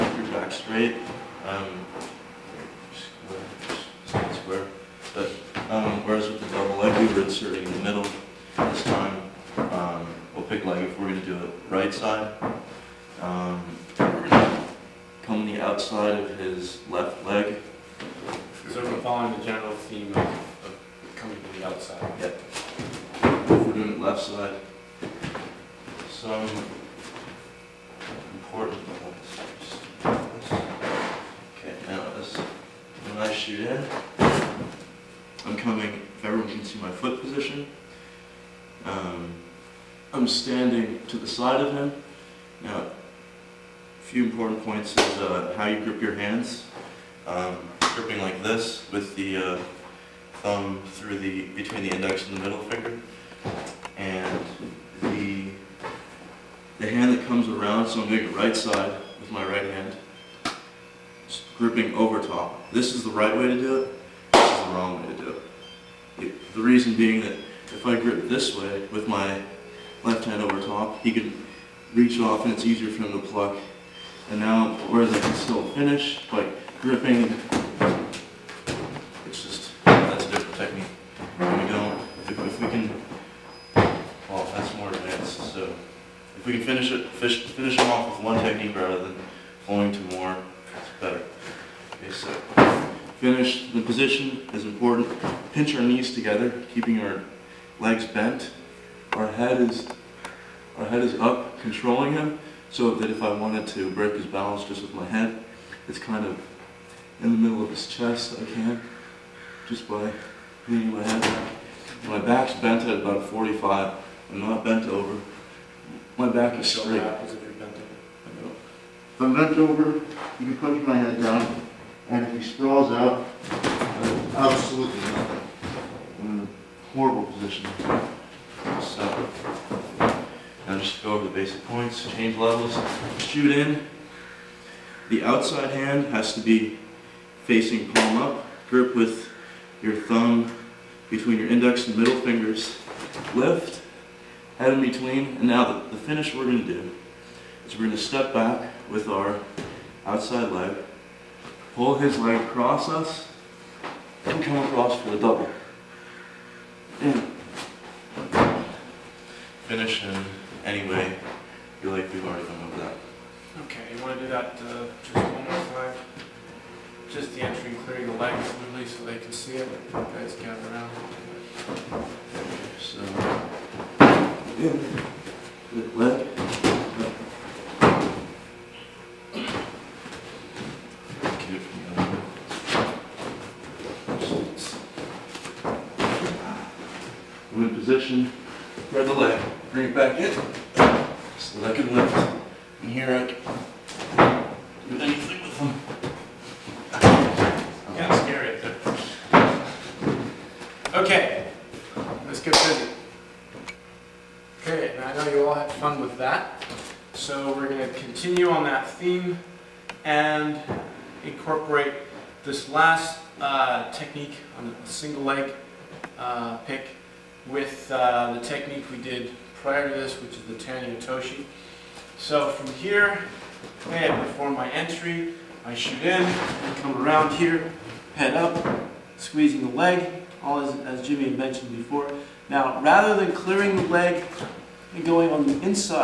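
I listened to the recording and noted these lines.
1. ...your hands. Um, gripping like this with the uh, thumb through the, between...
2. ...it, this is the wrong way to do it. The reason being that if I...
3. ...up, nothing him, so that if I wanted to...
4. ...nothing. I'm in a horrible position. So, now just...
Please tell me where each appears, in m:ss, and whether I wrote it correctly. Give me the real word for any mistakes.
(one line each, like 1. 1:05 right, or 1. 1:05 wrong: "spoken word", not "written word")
1. 0:46 right
2. 1:03 right
3. 1:41 wrong: "controlling", not "nothing"
4. 2:04 right.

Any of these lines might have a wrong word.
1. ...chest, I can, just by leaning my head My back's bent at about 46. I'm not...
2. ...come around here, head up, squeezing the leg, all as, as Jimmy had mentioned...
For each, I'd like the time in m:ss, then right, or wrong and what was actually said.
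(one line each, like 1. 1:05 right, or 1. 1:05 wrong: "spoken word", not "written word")
1. 1:47 wrong: "45", not "46"
2. 3:46 right.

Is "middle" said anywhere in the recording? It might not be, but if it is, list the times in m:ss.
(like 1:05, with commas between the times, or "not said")
0:07, 0:52, 1:47, 2:21.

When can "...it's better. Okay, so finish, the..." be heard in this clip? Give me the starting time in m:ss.
1:30.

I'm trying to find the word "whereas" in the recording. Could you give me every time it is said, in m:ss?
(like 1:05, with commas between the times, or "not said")
0:06, 1:14.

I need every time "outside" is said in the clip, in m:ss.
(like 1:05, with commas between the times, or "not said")
0:15, 0:21, 2:15, 2:30.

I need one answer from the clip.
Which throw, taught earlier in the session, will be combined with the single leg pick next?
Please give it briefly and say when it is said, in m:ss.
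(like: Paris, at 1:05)
Tani Otoshi, at 3:40.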